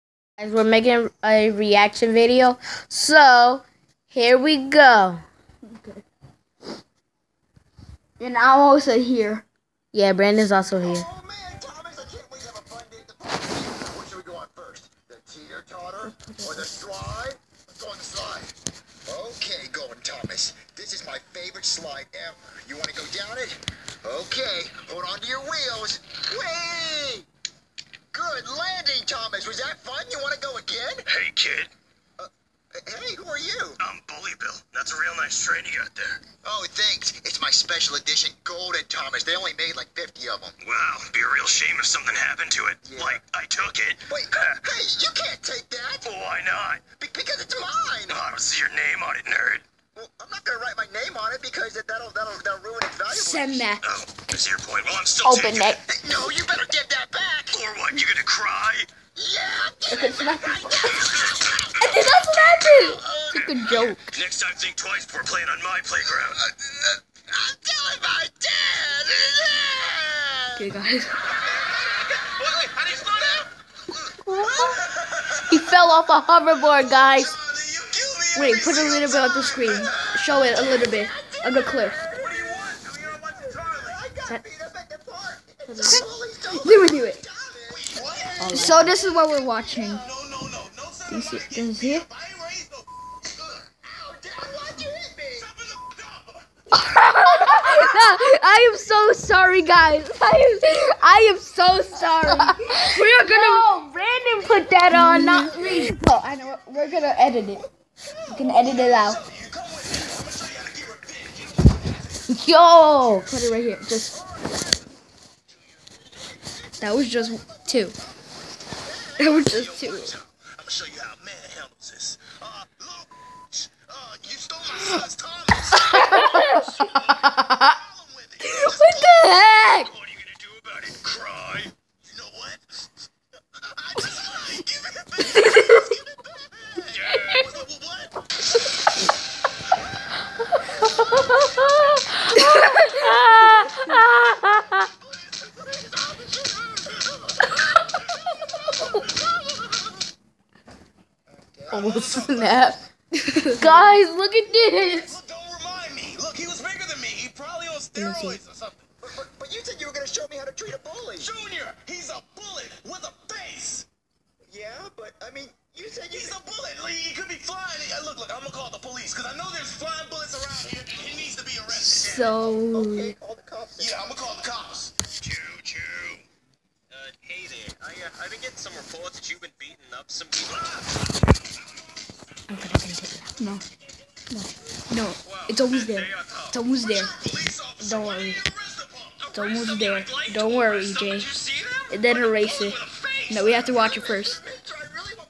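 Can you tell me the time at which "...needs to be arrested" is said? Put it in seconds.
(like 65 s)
171 s.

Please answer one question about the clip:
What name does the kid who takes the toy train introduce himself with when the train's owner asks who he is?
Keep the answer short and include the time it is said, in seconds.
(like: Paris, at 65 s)
Bully Bill, at 34 s.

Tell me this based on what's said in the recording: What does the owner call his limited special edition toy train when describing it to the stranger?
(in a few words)
Golden Thomas.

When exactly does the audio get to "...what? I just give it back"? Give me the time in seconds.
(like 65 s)
132 s.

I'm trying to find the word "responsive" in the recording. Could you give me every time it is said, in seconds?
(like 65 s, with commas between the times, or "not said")
not said.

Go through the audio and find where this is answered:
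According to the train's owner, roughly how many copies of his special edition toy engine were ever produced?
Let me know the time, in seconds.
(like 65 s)
39 s.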